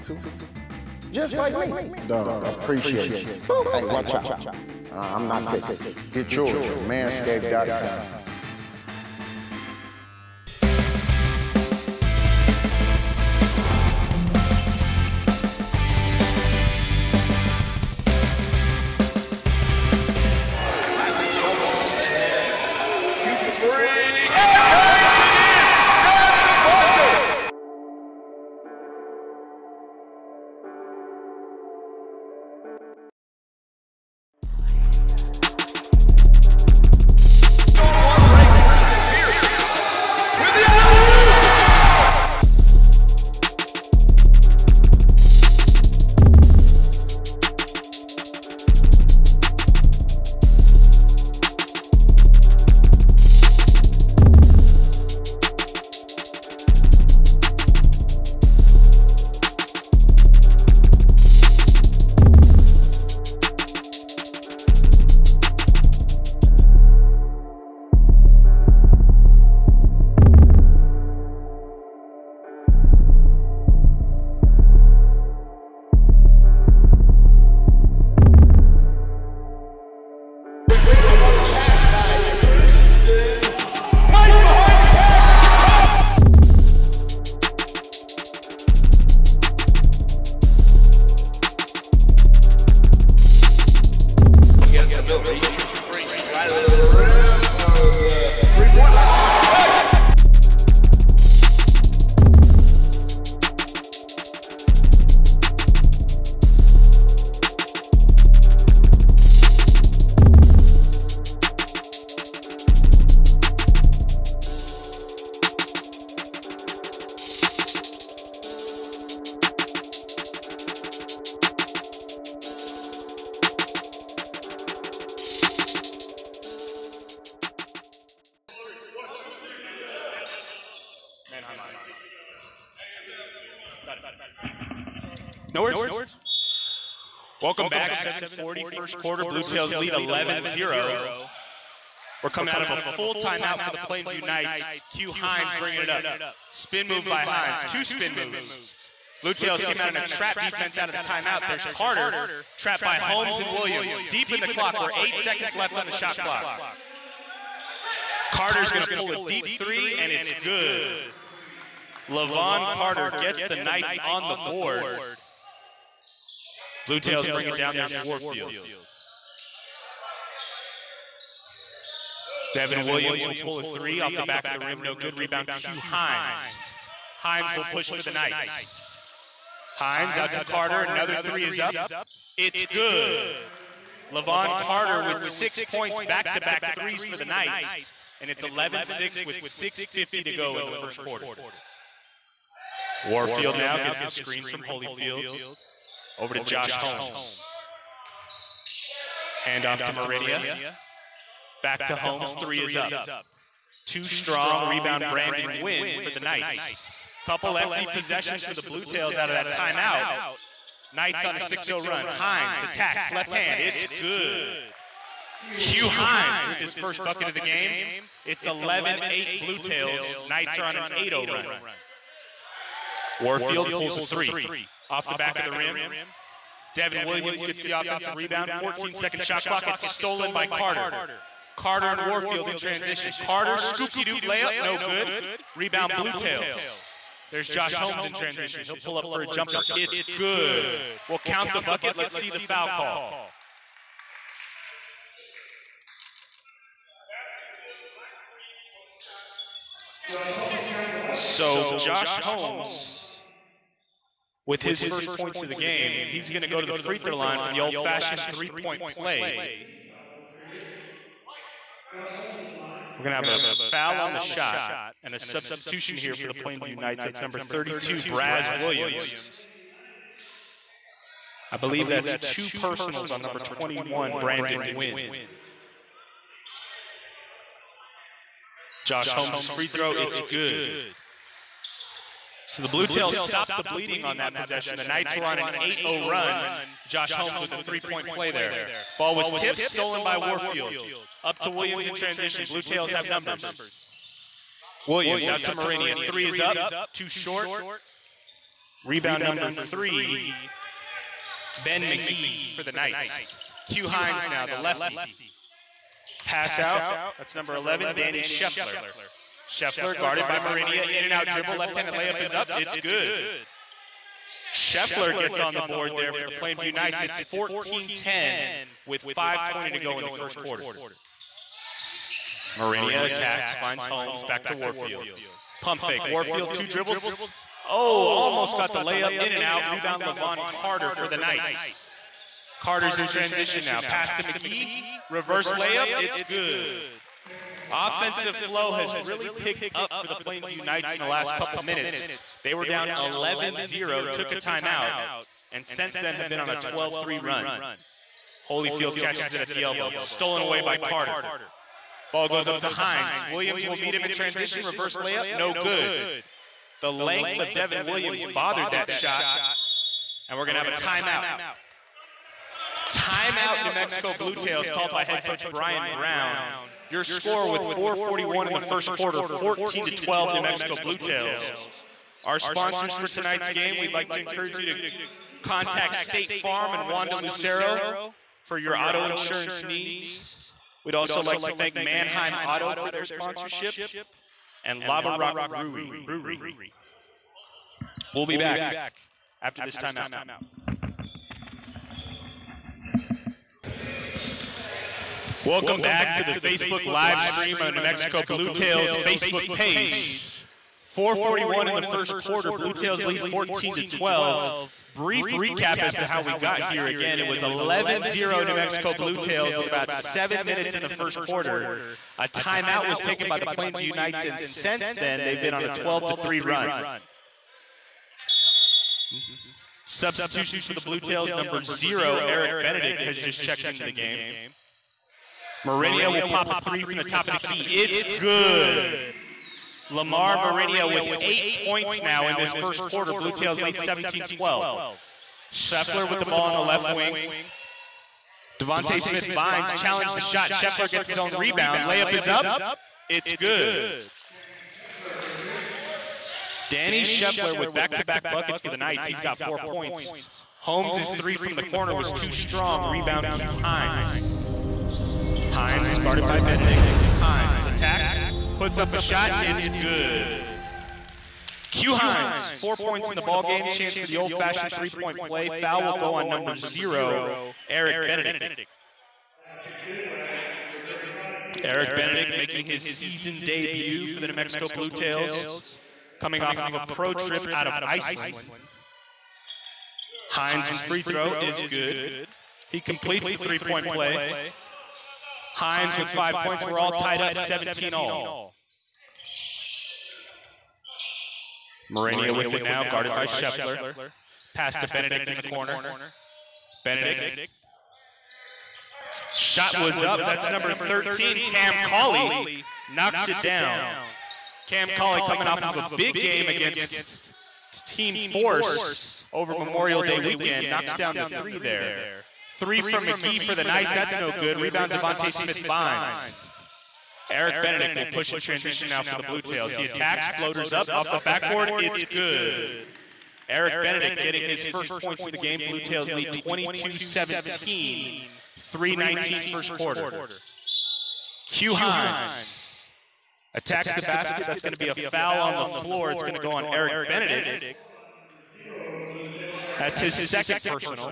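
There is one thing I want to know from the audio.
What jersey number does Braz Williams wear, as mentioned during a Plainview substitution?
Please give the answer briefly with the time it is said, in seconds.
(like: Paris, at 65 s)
32, at 267 s.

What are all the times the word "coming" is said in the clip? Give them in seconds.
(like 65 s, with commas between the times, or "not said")
142 s, 476 s, 505 s.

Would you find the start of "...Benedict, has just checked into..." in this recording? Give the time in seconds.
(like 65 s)
422 s.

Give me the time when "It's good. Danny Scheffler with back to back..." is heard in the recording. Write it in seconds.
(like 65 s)
443 s.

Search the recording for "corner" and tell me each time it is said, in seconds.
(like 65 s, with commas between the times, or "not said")
451 s, 495 s.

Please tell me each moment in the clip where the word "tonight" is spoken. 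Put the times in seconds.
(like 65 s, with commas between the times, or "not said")
373 s.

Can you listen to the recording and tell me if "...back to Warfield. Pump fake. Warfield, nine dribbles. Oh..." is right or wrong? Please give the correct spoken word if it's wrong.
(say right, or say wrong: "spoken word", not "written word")
wrong: "two", not "nine".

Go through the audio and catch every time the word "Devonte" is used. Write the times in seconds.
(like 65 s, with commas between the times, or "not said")
438 s, 514 s.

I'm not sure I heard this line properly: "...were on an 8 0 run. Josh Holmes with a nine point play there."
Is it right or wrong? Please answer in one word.
wrong.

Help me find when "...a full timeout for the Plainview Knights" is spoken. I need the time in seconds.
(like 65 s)
142 s.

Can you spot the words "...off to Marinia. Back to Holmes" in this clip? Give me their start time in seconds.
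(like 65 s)
199 s.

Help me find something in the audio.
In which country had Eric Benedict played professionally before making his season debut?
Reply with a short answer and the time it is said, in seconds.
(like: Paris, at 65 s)
Iceland, at 477 s.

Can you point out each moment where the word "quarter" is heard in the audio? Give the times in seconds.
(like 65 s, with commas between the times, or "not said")
138 s, 191 s, 320 s, 368 s, 402 s, 411 s, 432 s, 529 s.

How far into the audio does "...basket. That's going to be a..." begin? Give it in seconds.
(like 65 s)
534 s.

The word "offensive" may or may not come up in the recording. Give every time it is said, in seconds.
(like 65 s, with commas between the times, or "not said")
227 s, 337 s.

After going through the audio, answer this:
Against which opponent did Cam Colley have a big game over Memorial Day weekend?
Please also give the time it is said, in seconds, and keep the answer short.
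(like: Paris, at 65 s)
Team Force, at 507 s.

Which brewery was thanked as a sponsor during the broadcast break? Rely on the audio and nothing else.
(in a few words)
Lava Rock Brewery.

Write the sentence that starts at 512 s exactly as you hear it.
Three from McGee for the Knights.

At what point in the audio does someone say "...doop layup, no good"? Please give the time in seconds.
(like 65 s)
234 s.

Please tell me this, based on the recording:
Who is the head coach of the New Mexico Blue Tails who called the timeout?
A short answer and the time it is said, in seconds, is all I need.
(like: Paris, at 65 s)
Brian Brown, at 365 s.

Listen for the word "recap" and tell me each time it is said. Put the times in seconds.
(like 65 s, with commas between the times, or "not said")
405 s.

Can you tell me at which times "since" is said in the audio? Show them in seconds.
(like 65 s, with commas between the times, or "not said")
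345 s, 414 s.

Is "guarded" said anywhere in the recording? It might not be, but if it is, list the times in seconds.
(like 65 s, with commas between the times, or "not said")
309 s, 455 s, 492 s.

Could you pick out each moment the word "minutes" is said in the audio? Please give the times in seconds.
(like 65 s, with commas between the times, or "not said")
341 s, 410 s.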